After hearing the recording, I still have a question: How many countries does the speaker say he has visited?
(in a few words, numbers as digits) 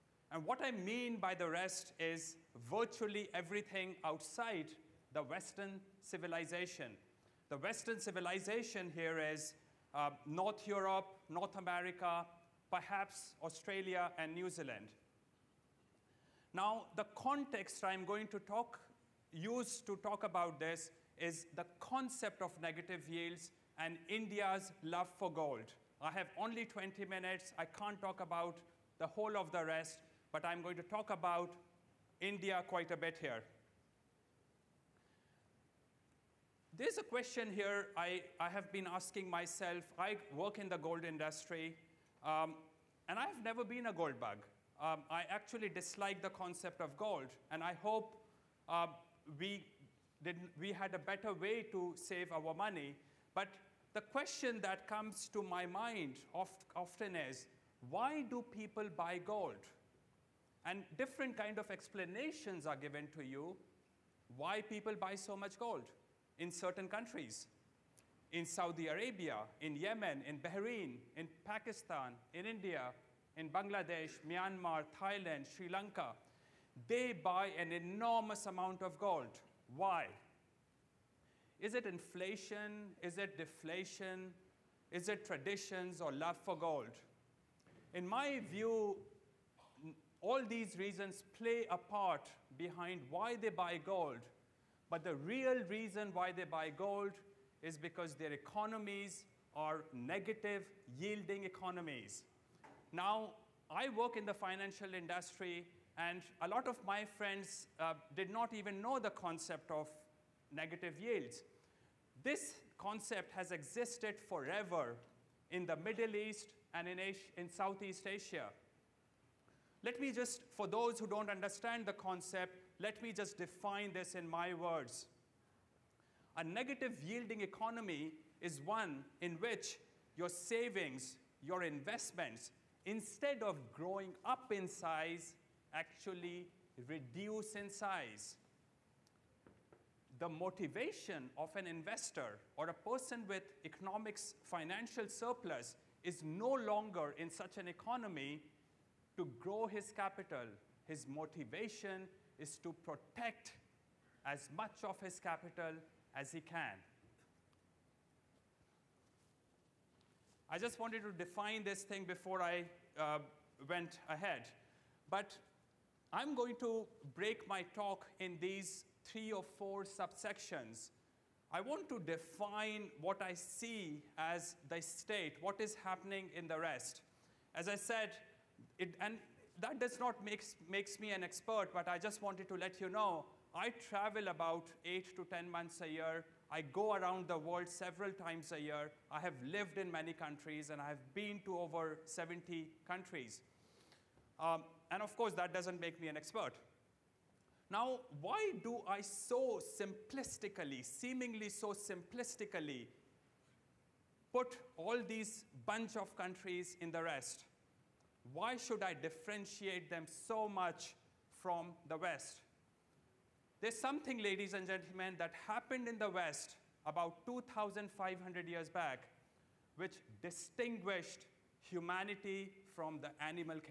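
Over 70.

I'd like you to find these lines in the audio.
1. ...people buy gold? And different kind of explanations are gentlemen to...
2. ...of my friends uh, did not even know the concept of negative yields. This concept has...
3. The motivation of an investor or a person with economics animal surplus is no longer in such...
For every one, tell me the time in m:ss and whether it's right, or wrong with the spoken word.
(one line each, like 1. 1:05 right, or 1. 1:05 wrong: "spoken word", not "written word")
1. 0:58 wrong: "given", not "gentlemen"
2. 1:46 right
3. 2:20 wrong: "financial", not "animal".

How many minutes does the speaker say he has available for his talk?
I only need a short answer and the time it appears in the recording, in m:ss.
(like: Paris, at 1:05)
20, at 0:26.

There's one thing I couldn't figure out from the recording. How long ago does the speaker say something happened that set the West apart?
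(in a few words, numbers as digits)
About 2,500 years.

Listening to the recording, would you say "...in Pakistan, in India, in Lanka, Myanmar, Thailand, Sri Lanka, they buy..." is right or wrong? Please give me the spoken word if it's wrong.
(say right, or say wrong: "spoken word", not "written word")
wrong: "Bangladesh", not "Lanka".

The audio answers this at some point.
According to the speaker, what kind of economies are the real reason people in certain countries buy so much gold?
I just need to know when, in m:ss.
1:39.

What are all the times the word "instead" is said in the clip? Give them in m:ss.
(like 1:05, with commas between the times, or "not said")
2:12.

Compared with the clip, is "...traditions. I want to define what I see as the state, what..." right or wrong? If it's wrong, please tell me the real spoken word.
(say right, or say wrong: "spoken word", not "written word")
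wrong: "subsections", not "traditions".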